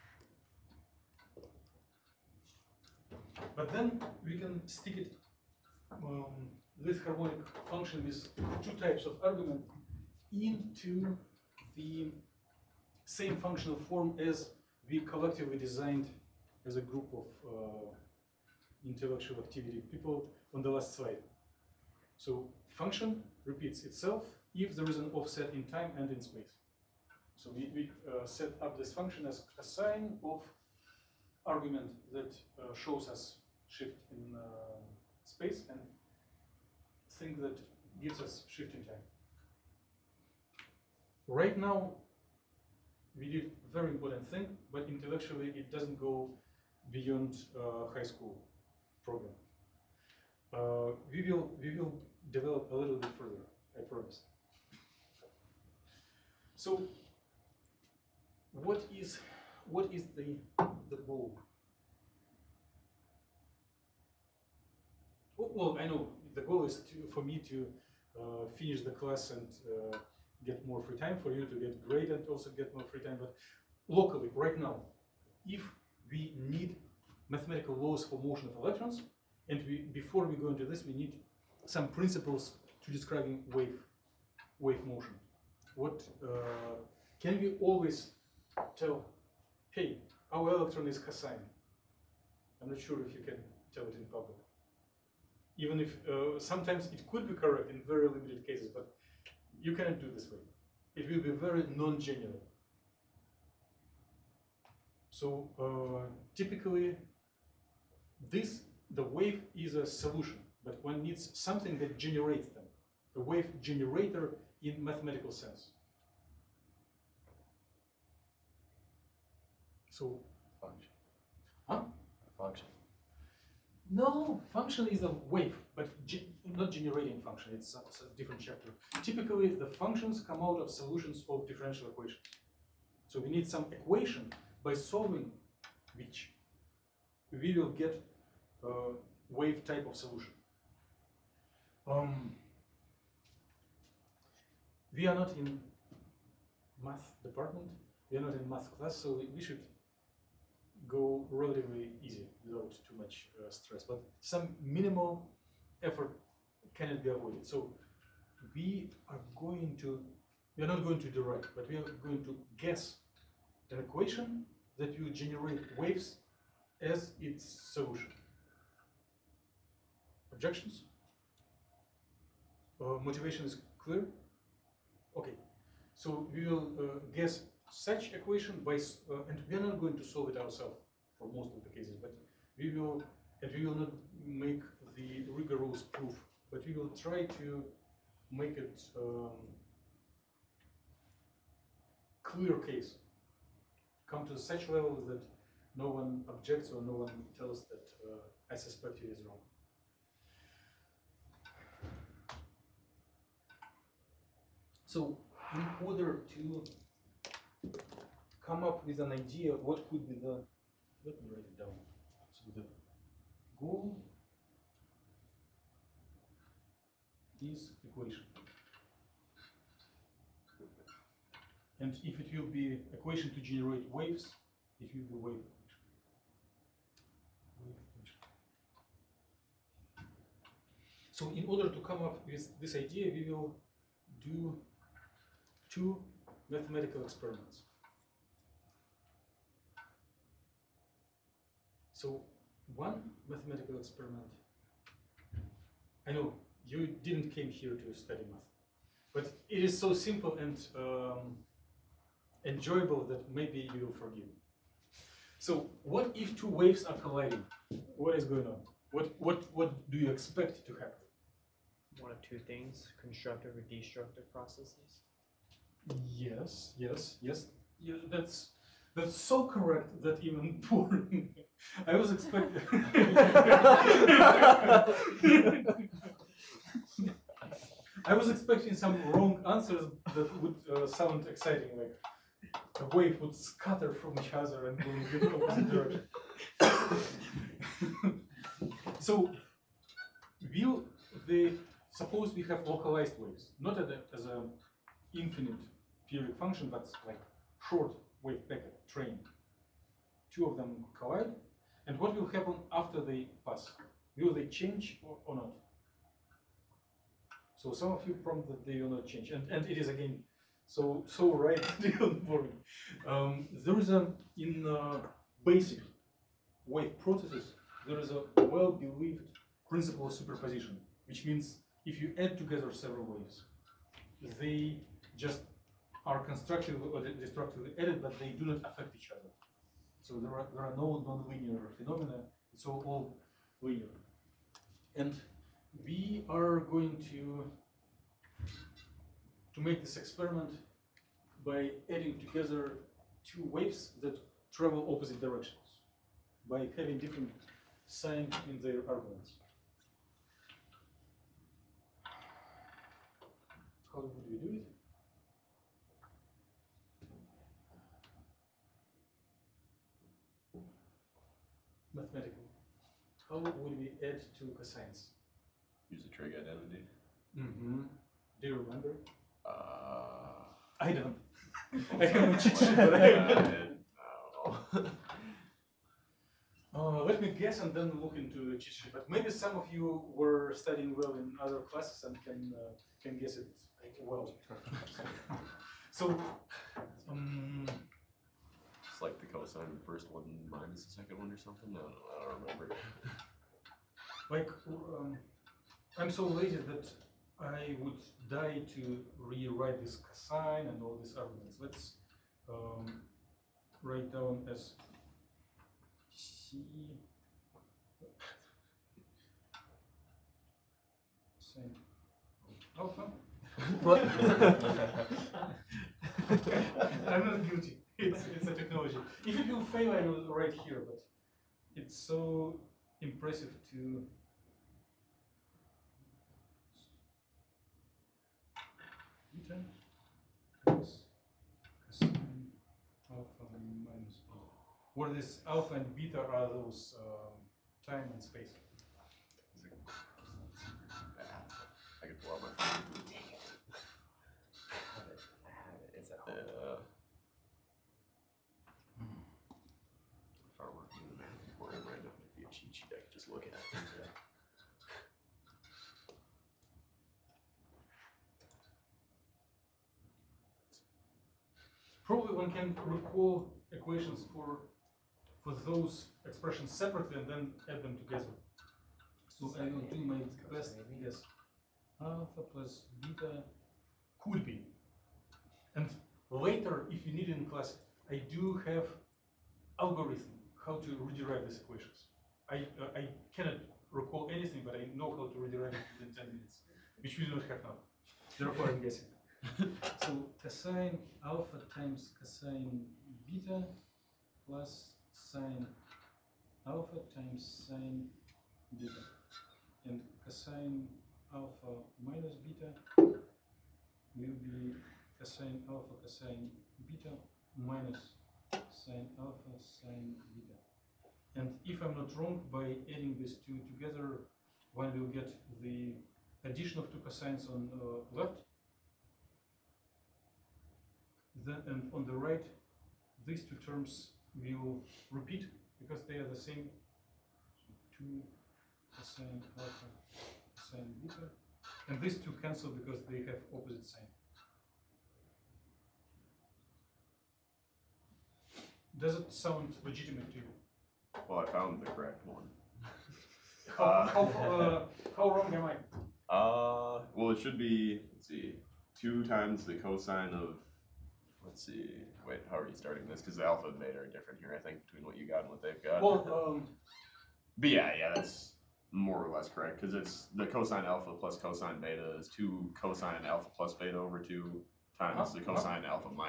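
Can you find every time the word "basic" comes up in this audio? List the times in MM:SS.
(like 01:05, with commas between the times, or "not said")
05:15.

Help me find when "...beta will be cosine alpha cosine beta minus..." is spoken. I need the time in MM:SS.
08:22.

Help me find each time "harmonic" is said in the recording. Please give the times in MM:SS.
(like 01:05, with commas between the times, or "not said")
00:07.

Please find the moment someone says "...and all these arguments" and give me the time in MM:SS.
06:40.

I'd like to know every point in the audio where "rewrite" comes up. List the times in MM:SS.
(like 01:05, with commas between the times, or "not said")
06:39, 08:01, 08:05.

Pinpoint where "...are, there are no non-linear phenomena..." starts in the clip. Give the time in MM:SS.
05:30.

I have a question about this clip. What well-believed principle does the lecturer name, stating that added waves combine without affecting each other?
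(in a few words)
principle of superposition.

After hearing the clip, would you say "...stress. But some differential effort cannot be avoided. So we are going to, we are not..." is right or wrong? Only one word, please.
wrong.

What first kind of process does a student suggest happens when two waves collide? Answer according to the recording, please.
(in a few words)
constructive.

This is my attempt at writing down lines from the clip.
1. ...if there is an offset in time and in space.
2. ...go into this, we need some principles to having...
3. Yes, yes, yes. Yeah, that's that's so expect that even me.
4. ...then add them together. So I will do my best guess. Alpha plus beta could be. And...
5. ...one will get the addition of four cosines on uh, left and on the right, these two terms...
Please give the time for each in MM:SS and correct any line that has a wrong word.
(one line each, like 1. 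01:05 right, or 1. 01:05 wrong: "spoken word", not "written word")
1. 00:24 right
2. 01:20 wrong: "describing", not "having"
3. 04:26 wrong: "correct", not "expect"
4. 07:47 right
5. 08:34 wrong: "two", not "four".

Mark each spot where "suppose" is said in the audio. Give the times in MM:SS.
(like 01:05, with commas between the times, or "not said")
04:51.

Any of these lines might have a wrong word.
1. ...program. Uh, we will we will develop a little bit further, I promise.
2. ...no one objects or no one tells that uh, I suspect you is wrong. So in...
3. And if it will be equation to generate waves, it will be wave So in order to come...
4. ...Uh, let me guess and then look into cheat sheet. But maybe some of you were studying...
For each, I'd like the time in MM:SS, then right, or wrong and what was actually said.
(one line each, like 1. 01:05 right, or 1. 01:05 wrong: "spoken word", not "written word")
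1. 00:49 right
2. 03:15 right
3. 03:41 right
4. 06:16 right.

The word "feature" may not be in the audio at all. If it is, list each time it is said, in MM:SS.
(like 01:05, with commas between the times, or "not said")
not said.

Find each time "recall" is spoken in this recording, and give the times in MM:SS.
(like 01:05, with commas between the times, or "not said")
07:42, 08:03.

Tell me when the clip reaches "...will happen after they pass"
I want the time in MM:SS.
05:02.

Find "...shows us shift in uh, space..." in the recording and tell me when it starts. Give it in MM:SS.
00:32.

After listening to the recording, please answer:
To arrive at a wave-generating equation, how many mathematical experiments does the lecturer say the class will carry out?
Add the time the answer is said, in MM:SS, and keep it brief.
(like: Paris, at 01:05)
2, at 03:55.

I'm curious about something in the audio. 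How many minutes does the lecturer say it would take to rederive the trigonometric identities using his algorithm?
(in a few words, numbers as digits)
10.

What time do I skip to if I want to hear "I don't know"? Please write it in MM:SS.
06:31.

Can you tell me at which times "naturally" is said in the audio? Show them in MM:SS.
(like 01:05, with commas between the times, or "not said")
not said.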